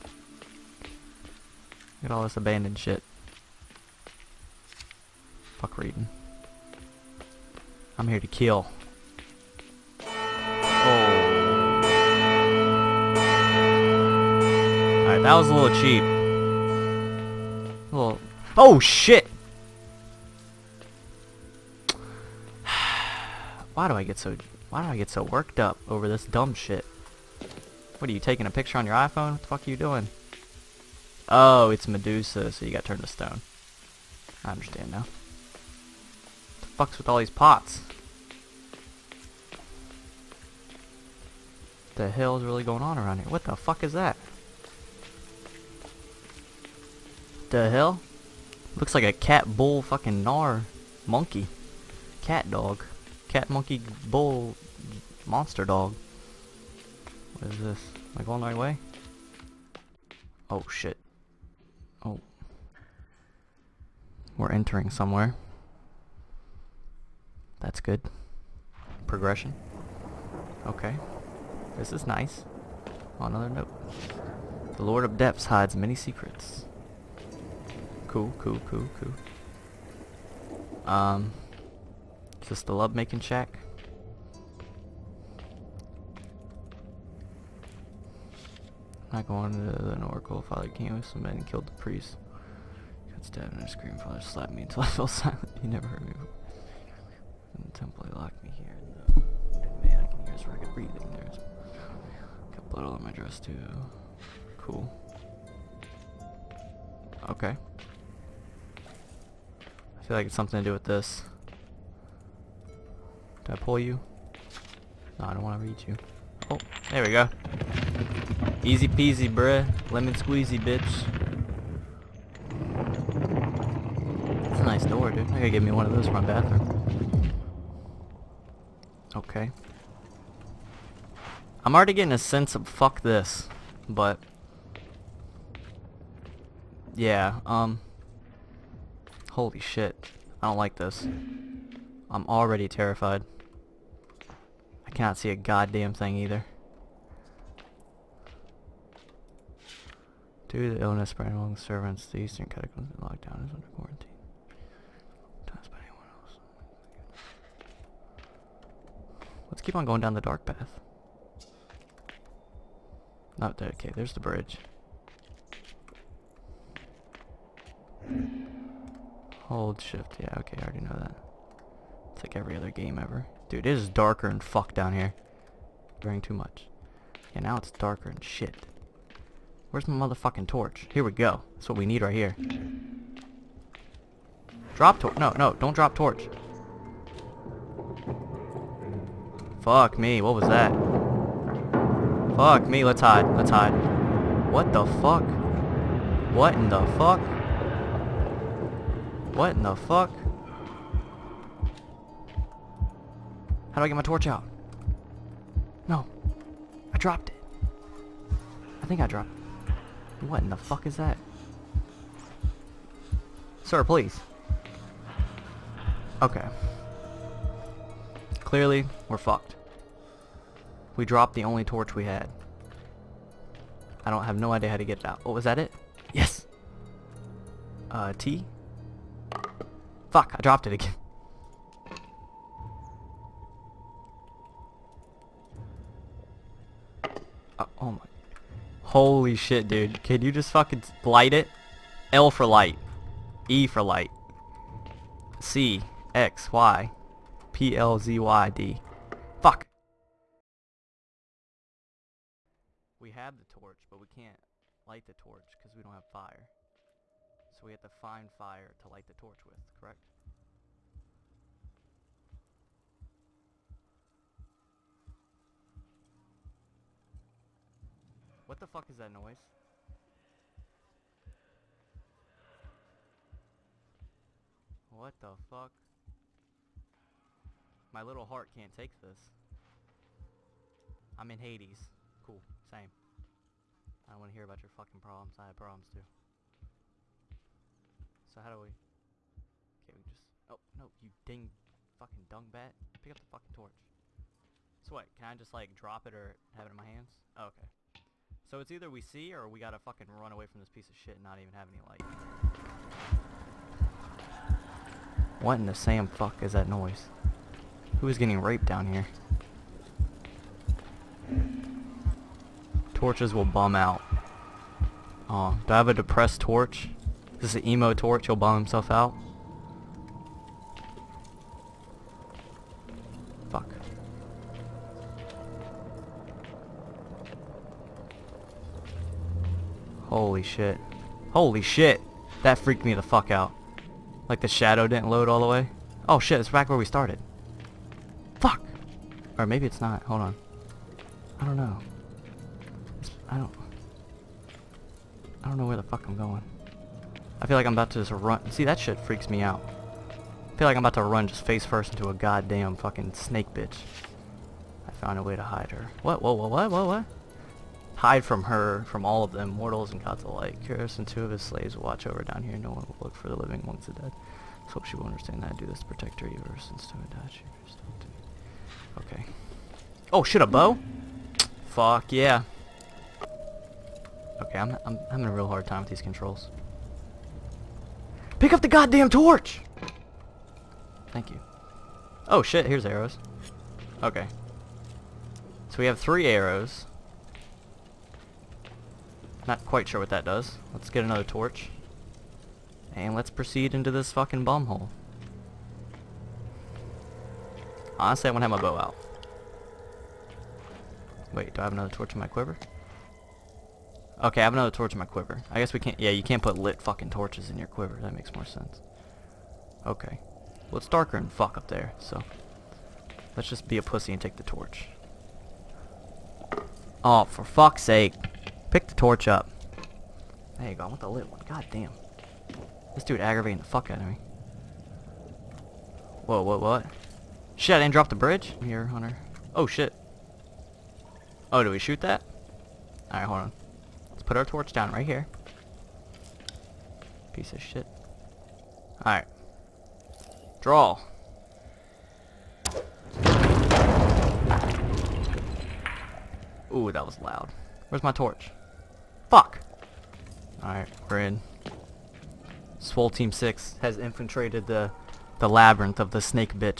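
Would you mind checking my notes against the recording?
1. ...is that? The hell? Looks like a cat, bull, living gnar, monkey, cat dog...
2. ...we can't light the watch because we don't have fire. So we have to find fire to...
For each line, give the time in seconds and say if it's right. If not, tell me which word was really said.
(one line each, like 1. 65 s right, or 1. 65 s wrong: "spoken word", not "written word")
1. 43 s wrong: "fucking", not "living"
2. 253 s wrong: "torch", not "watch".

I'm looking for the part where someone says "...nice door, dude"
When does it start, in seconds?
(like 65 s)
124 s.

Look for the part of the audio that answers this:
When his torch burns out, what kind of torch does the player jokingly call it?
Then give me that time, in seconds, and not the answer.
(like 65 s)
317 s.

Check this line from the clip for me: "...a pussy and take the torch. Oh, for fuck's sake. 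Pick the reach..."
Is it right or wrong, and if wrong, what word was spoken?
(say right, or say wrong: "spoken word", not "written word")
wrong: "torch", not "reach".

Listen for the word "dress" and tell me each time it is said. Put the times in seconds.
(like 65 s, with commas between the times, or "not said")
103 s.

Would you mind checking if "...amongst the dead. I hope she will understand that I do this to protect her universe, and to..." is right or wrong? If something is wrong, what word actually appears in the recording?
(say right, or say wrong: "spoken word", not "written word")
right.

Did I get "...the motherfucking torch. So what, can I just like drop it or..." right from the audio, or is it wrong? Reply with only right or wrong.
wrong.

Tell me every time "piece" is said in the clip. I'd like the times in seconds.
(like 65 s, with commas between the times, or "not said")
300 s, 437 s.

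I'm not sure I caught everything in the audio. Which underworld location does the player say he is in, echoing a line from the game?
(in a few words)
Hades.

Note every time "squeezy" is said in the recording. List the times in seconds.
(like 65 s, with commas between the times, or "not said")
120 s.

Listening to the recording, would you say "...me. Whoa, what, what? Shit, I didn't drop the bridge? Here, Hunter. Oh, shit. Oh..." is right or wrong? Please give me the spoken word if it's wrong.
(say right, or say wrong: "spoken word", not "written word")
right.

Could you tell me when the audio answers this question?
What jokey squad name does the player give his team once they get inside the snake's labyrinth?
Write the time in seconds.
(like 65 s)
452 s.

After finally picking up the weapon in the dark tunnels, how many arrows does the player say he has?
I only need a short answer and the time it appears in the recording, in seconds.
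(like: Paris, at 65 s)
3, at 385 s.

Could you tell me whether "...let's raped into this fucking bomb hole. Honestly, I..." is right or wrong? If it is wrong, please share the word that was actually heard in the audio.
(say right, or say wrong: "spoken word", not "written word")
wrong: "proceed", not "raped".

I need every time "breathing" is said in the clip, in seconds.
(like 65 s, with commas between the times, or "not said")
100 s.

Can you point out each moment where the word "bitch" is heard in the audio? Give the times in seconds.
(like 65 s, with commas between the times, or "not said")
120 s, 353 s.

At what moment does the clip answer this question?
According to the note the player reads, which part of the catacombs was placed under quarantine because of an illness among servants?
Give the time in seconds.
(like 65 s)
152 s.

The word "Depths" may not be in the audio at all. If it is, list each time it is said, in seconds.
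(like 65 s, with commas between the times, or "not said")
75 s.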